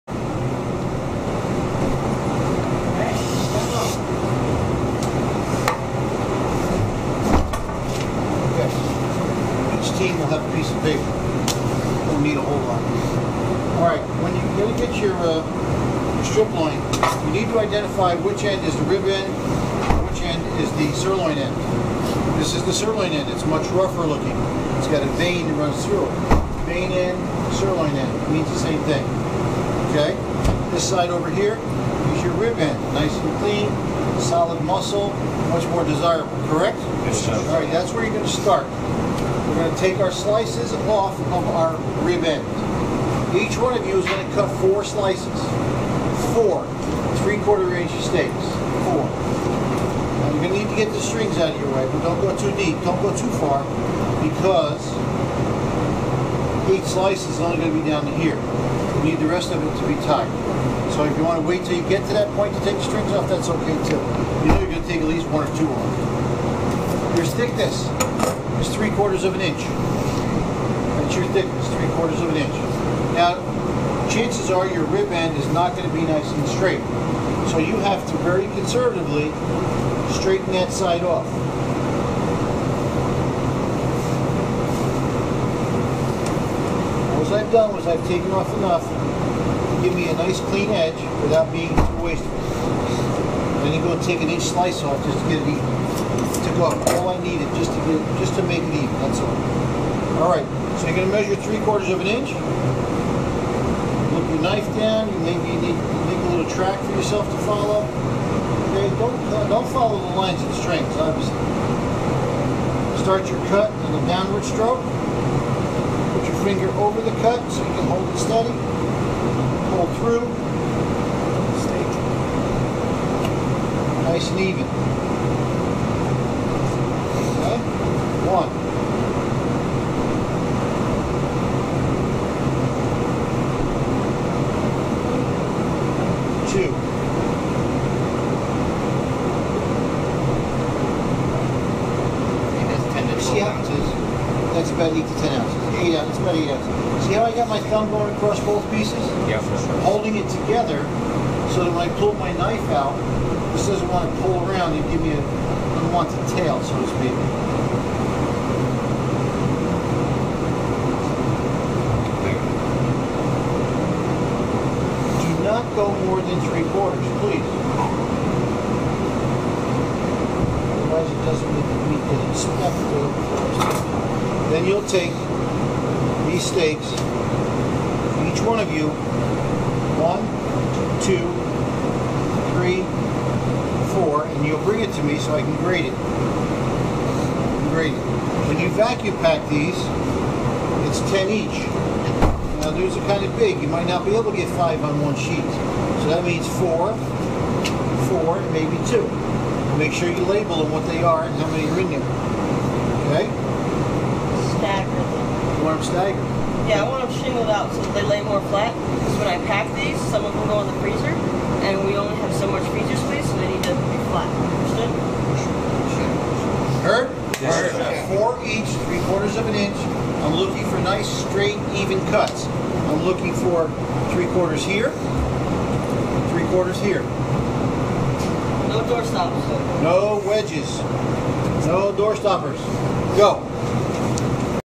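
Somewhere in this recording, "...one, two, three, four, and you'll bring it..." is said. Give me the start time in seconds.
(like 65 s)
179 s.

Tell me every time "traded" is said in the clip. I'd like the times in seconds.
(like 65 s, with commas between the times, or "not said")
not said.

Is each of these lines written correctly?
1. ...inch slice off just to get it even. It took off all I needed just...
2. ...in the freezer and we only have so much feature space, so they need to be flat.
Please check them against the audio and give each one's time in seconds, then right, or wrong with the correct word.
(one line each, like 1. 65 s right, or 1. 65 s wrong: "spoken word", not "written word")
1. 94 s right
2. 210 s right.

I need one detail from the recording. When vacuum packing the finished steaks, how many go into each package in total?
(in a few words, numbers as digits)
10.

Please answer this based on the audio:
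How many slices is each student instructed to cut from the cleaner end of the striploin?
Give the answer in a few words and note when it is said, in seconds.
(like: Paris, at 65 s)
4, at 43 s.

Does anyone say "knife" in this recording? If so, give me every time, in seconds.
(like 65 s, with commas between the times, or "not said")
104 s, 152 s.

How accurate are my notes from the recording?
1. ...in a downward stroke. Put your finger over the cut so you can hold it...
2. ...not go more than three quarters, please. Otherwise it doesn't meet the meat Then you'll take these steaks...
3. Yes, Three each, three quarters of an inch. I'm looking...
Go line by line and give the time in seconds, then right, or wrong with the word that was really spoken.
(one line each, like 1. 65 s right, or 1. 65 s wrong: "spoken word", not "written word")
1. 113 s right
2. 165 s right
3. 217 s wrong: "Four", not "Three".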